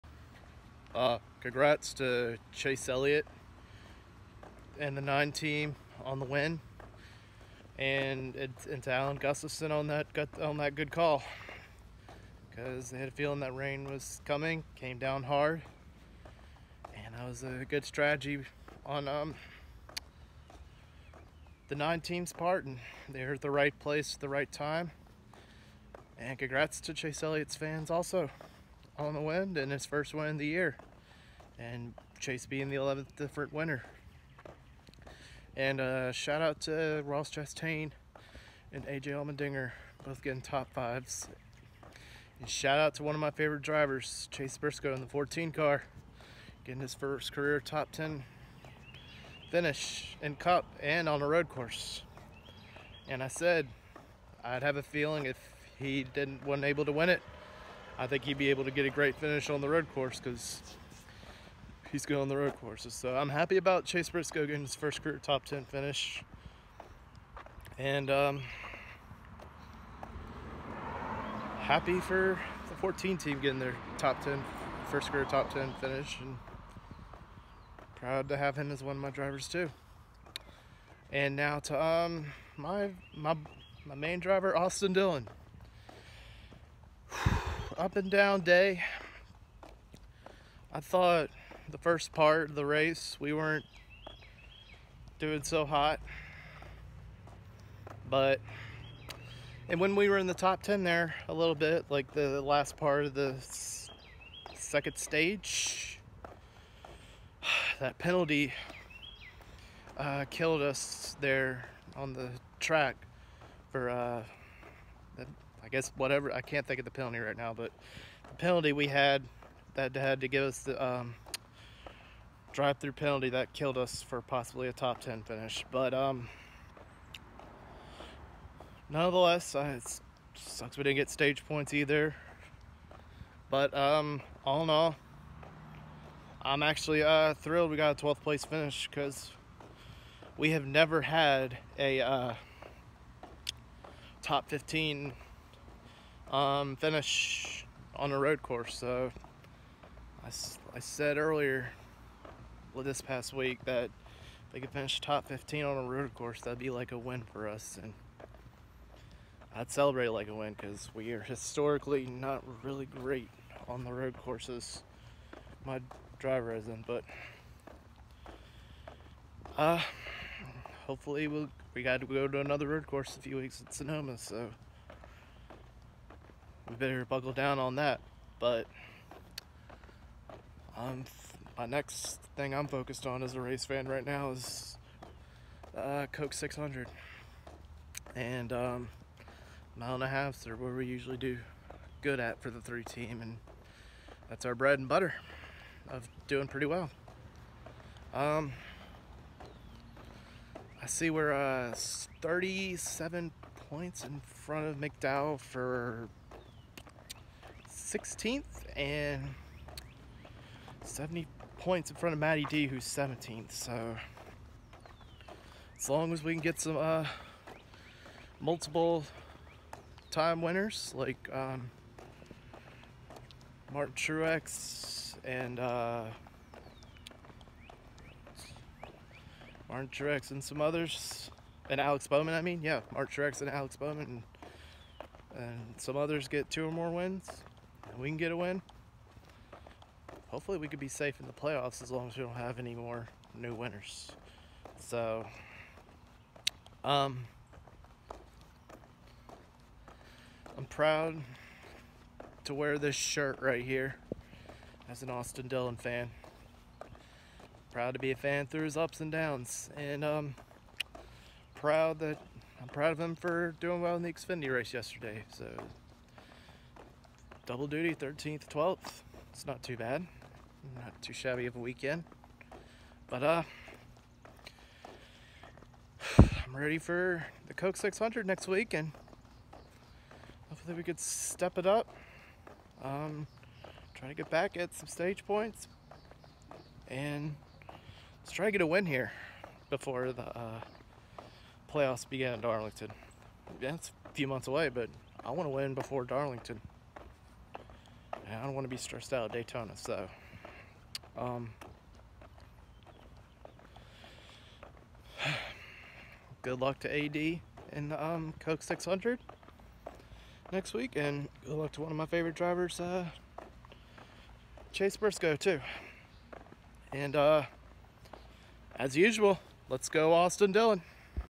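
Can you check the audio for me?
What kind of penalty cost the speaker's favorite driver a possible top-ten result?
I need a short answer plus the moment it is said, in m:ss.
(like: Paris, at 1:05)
drive-through penalty, at 2:02.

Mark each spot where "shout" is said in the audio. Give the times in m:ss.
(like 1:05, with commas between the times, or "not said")
0:36, 0:42.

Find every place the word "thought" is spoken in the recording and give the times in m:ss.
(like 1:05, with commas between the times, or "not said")
1:30.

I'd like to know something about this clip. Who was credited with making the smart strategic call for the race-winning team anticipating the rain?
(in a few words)
Alan Gustafson.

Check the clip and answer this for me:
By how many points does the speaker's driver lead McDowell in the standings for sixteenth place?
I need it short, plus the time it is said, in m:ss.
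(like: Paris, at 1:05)
37, at 3:22.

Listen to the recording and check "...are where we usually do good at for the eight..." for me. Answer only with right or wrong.
wrong.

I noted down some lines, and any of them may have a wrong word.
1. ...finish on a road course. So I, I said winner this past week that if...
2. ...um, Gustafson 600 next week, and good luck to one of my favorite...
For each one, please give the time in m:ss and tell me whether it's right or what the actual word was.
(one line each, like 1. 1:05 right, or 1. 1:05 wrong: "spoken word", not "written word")
1. 2:26 wrong: "earlier", not "winner"
2. 5:08 wrong: "Coke", not "Gustafson".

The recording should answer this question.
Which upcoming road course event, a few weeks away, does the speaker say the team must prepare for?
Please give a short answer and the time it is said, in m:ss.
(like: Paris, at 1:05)
Sonoma, at 2:53.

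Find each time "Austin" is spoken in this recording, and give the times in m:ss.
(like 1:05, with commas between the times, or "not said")
1:24, 4:15, 5:20.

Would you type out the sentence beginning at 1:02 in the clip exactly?
So I'm happy about Chase Briscoe getting his first career top 10 finish.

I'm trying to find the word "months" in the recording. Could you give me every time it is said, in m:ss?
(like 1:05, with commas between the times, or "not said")
4:54.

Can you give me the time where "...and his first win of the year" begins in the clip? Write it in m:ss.
0:29.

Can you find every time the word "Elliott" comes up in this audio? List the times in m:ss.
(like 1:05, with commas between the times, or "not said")
0:02, 0:27.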